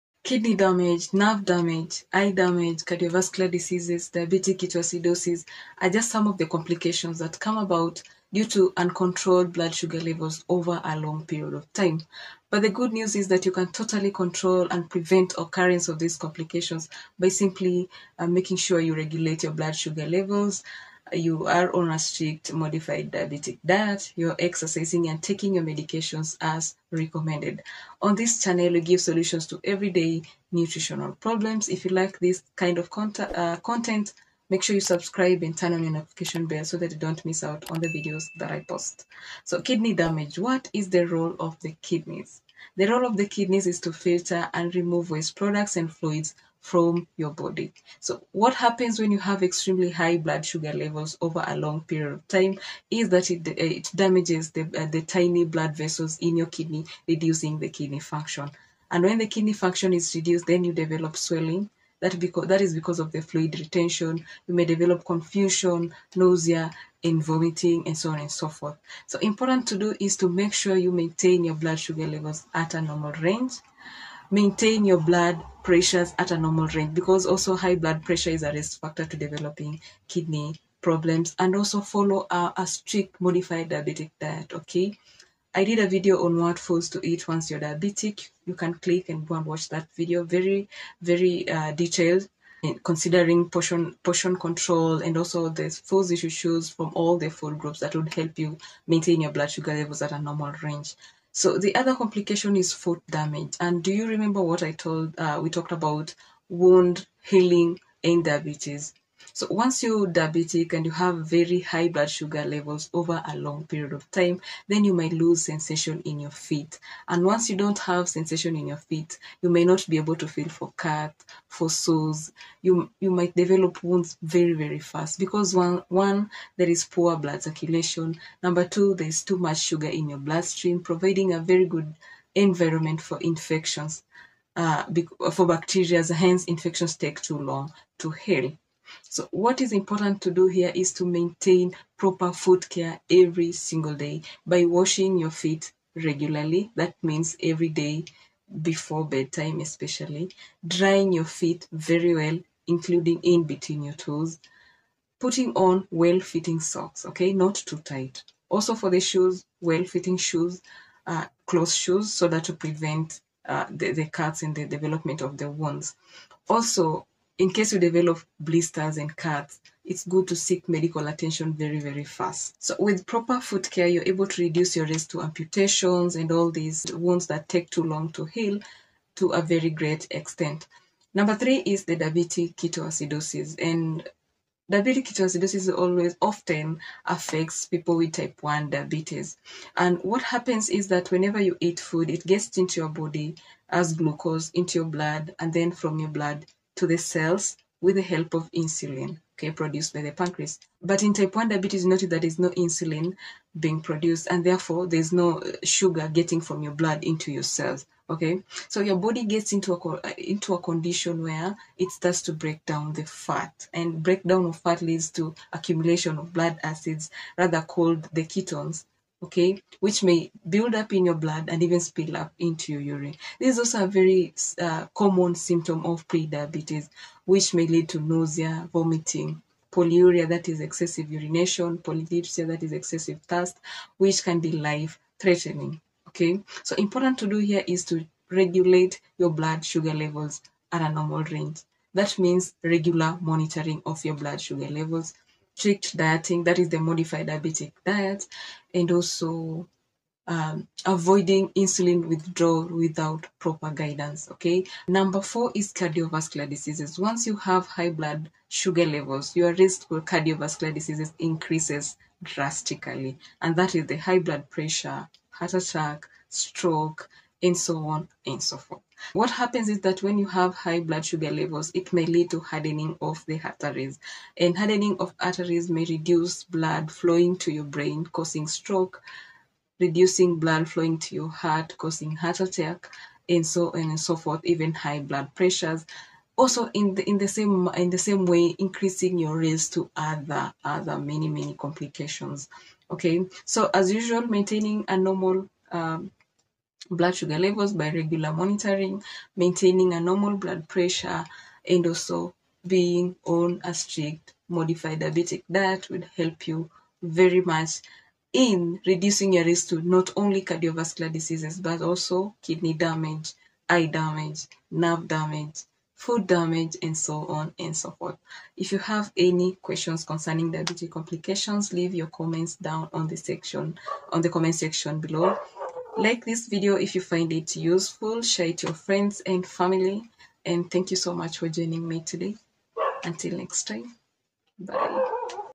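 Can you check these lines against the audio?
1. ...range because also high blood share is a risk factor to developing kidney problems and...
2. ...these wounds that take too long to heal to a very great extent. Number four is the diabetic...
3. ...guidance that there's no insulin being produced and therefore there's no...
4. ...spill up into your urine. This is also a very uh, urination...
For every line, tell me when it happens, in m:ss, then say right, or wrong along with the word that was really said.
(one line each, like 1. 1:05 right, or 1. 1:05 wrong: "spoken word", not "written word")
1. 1:16 wrong: "pressure", not "share"
2. 2:56 wrong: "three", not "four"
3. 3:21 wrong: "notice", not "guidance"
4. 3:41 wrong: "common", not "urination".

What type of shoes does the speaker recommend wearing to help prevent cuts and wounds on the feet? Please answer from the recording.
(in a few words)
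Closed shoes.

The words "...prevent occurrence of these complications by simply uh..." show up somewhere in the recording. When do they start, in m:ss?
0:14.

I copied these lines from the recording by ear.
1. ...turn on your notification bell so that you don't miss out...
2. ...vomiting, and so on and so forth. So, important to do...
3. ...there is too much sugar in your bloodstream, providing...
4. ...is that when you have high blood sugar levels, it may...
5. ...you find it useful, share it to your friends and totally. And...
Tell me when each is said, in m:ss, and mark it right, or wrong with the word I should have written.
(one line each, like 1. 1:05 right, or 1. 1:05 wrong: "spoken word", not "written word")
1. 0:35 right
2. 1:07 right
3. 2:08 right
4. 4:29 right
5. 5:26 wrong: "family", not "totally".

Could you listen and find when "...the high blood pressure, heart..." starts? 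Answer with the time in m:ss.
4:23.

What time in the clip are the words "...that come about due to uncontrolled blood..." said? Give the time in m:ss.
0:07.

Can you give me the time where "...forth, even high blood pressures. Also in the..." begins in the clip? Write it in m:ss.
4:44.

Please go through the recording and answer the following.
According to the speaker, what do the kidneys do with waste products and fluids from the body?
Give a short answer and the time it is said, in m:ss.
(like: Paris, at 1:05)
Filter and remove, at 0:43.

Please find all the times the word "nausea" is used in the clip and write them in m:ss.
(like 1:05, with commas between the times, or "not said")
1:06, 3:47.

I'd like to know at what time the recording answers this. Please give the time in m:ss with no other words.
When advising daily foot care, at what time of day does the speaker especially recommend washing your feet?
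2:28.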